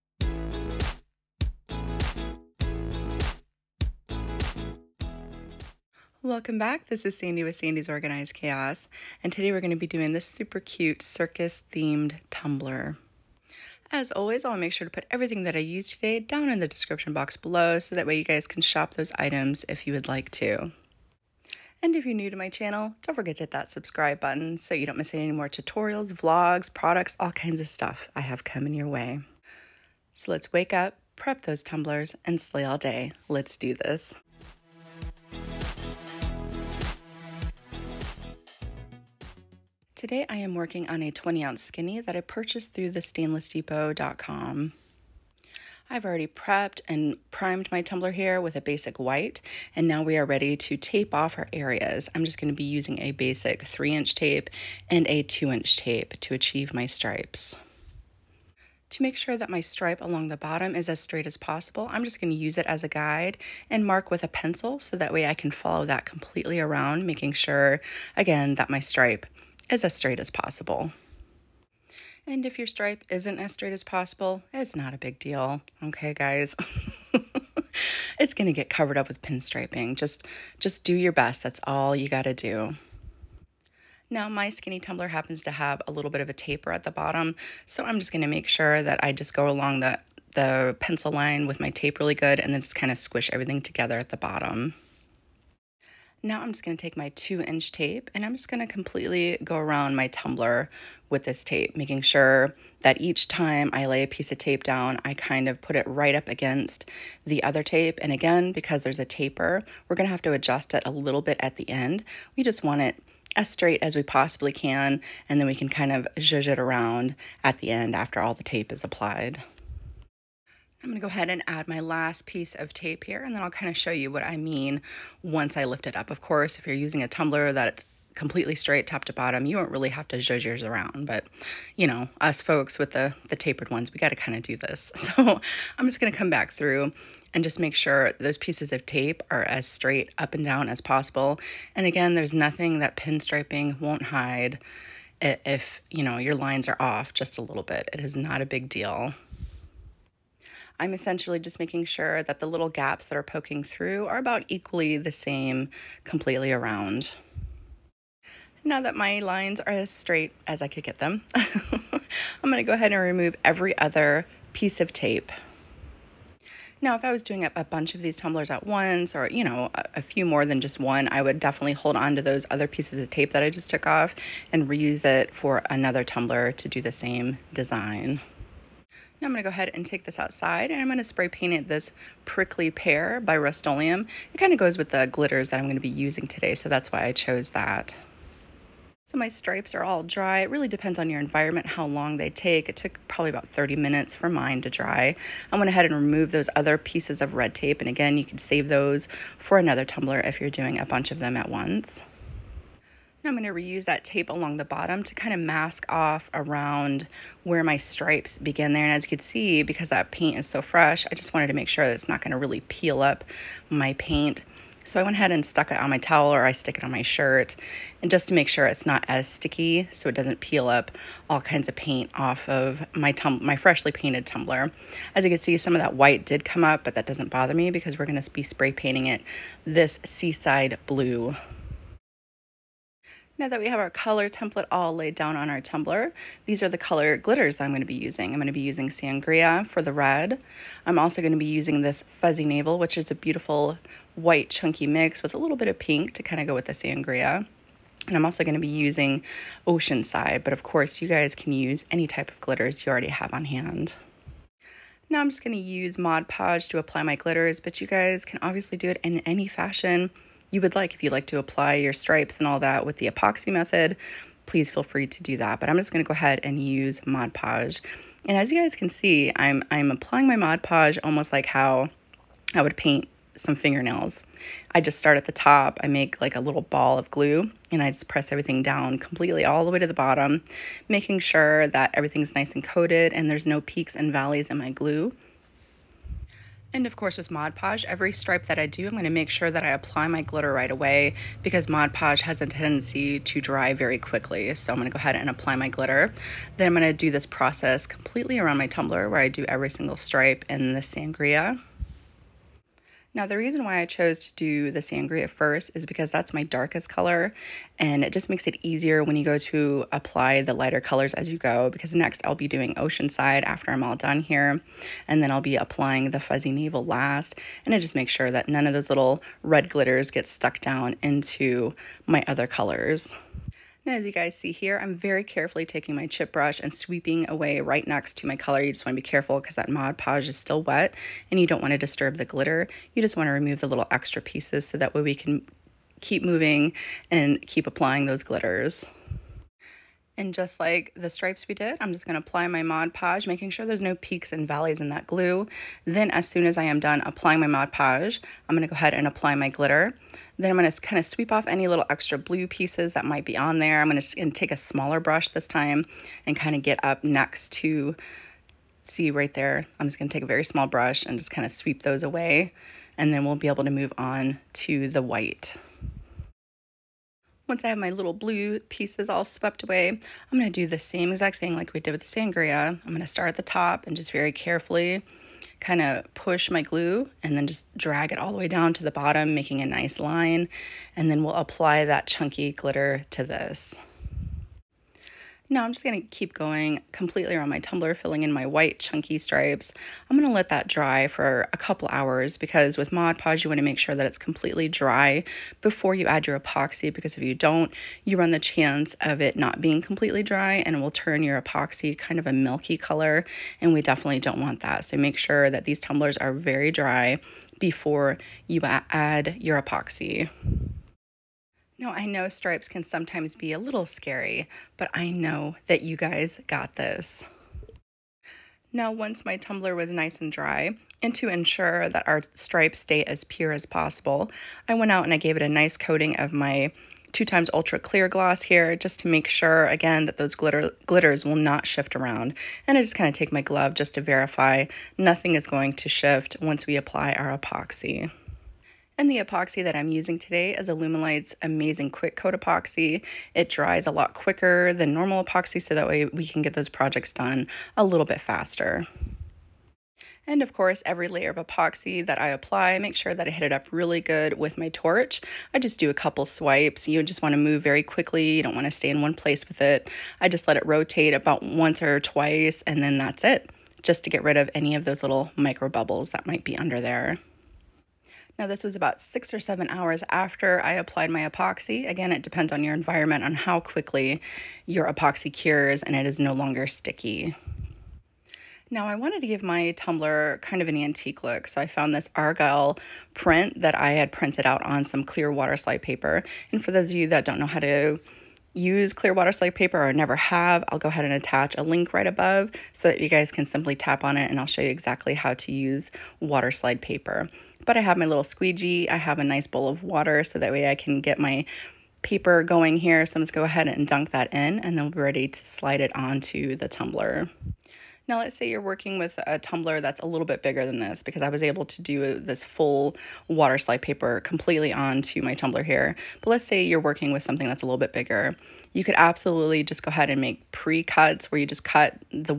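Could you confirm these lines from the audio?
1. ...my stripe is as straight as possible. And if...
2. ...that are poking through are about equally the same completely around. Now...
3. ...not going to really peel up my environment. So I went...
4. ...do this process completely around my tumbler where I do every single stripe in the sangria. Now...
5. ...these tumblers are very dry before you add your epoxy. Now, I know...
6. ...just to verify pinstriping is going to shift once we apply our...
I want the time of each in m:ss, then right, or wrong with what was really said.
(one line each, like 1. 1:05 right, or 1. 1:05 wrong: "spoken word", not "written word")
1. 1:08 right
2. 2:33 right
3. 3:32 wrong: "paint", not "environment"
4. 4:56 right
5. 6:45 right
6. 7:13 wrong: "nothing", not "pinstriping".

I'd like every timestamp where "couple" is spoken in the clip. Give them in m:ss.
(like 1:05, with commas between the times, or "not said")
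6:31, 7:35.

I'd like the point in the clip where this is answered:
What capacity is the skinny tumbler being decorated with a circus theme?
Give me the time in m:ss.
0:41.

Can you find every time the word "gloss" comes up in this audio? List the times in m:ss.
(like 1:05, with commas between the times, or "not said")
7:08.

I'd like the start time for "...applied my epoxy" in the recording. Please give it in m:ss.
7:50.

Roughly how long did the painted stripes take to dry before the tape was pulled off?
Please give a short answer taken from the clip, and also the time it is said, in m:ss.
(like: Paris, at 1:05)
30 minutes, at 3:13.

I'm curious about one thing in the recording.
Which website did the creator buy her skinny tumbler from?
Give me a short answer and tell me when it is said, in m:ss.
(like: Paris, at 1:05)
stainlessdepot.com, at 0:43.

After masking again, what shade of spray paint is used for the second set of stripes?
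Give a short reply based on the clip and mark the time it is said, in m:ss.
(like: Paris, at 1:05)
seaside blue, at 3:50.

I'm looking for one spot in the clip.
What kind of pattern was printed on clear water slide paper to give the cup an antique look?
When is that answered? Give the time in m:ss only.
8:02.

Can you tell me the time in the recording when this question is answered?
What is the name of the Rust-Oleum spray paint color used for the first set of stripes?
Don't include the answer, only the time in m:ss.
3:02.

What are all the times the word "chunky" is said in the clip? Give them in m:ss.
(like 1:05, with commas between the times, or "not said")
4:04, 6:22, 6:28.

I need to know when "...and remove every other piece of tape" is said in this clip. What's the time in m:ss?
2:42.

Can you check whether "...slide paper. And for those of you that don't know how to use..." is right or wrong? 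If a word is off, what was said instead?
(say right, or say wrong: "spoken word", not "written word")
right.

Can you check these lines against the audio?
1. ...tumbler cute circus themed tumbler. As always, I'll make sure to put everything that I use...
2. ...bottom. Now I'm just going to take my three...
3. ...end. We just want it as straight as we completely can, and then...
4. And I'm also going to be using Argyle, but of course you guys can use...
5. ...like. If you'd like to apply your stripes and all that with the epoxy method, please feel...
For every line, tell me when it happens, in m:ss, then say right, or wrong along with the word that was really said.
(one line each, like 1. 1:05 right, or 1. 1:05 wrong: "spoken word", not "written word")
1. 0:10 wrong: "super", not "tumbler"
2. 1:34 wrong: "two", not "three"
3. 1:51 wrong: "possibly", not "completely"
4. 4:08 wrong: "Oceanside", not "Argyle"
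5. 4:20 right.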